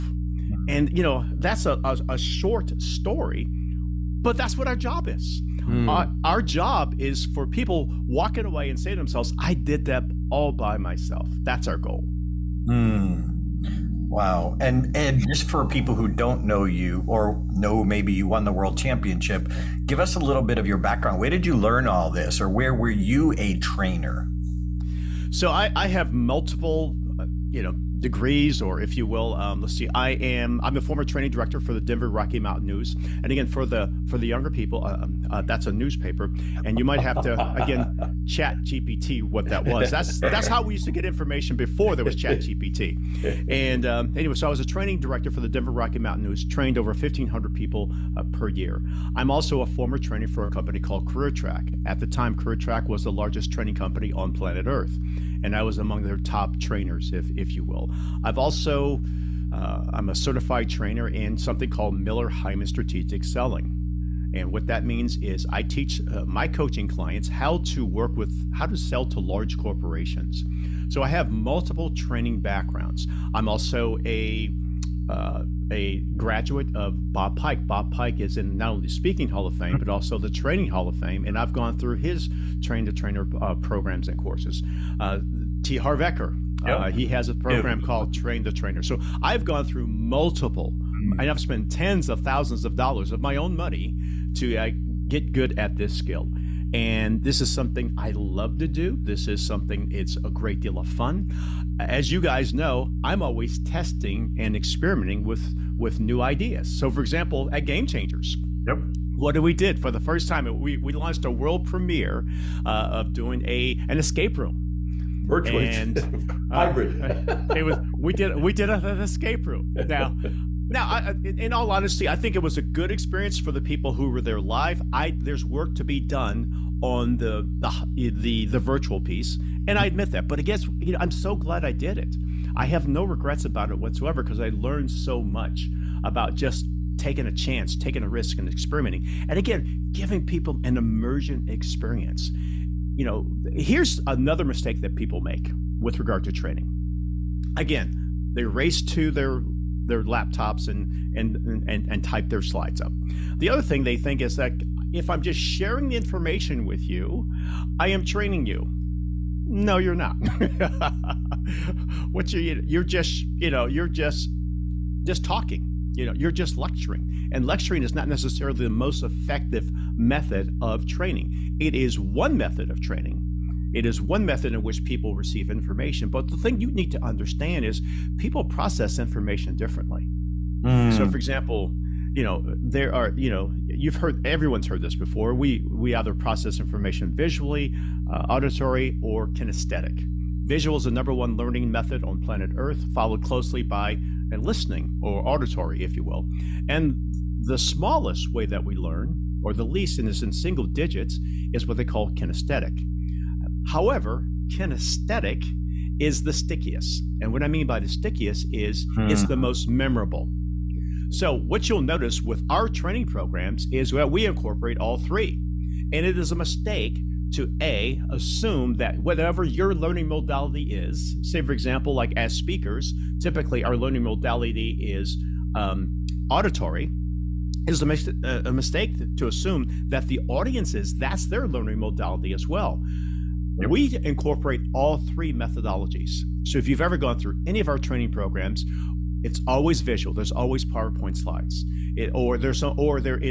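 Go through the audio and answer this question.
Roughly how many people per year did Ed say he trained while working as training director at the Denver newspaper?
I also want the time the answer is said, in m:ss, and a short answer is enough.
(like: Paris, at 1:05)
over 1500, at 0:46.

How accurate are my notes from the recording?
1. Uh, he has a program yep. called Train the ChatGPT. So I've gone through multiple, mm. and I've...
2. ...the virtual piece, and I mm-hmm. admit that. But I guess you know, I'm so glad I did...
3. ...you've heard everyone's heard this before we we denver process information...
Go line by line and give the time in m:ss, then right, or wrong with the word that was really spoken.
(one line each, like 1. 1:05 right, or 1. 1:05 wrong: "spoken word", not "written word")
1. 1:26 wrong: "Trainer", not "ChatGPT"
2. 2:08 right
3. 3:03 wrong: "either", not "denver".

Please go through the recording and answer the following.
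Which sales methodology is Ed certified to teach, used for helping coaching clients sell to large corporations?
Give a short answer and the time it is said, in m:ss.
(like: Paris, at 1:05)
Miller Heiman Strategic Selling, at 1:01.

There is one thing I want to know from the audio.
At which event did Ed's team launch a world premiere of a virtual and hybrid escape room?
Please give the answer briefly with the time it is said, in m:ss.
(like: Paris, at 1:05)
Game Changers, at 1:47.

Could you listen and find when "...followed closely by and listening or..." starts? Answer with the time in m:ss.
3:12.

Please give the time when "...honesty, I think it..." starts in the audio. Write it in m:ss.
2:01.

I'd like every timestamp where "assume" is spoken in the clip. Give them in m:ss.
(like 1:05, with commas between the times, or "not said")
3:38, 3:49.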